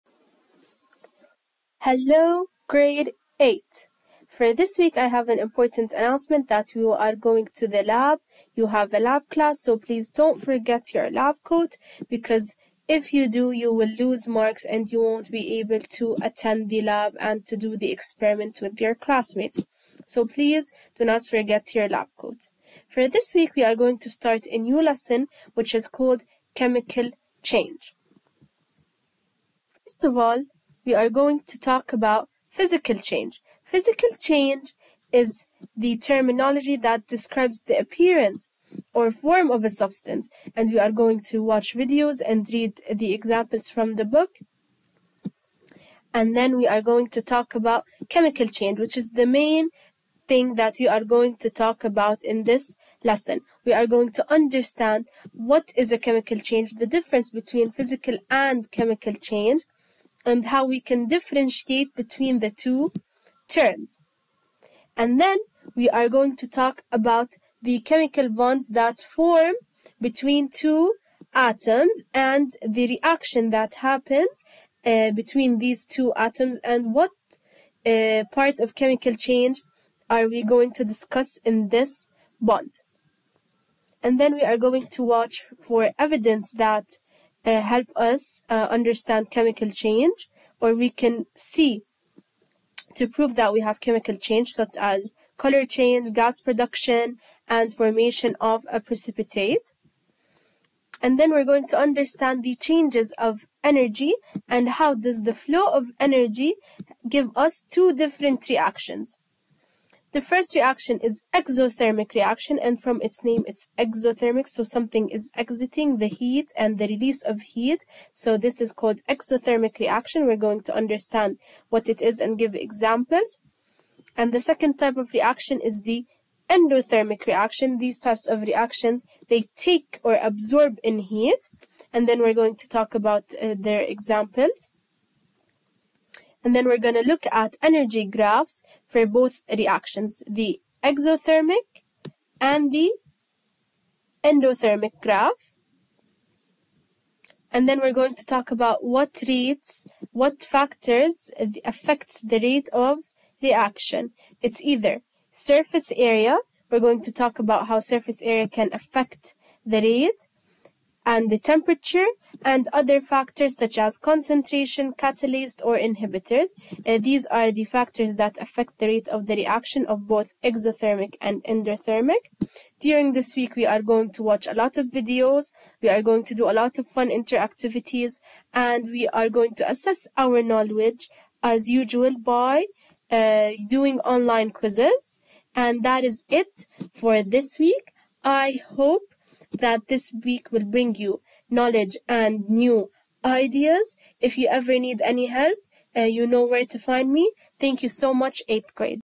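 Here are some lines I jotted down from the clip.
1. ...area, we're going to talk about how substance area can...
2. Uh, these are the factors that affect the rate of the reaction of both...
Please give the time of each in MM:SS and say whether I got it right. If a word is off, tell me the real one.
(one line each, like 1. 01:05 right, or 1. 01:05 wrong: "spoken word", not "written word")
1. 02:35 wrong: "surface", not "substance"
2. 02:46 right.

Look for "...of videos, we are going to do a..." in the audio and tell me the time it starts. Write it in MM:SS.
02:54.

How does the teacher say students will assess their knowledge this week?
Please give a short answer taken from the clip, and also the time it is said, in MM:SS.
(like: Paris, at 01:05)
online quizzes, at 03:04.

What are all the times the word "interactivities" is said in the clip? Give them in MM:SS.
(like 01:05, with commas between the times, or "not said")
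02:57.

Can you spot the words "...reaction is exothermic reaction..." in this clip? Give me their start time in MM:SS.
01:50.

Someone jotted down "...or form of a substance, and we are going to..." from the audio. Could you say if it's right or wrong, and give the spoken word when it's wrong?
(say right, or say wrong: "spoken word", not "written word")
right.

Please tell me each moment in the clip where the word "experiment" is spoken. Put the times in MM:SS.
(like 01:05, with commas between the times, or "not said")
00:17.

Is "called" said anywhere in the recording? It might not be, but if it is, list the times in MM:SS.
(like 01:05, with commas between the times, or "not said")
00:25, 01:58.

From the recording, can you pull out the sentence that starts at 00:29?
First of all, we are going to talk about physical change.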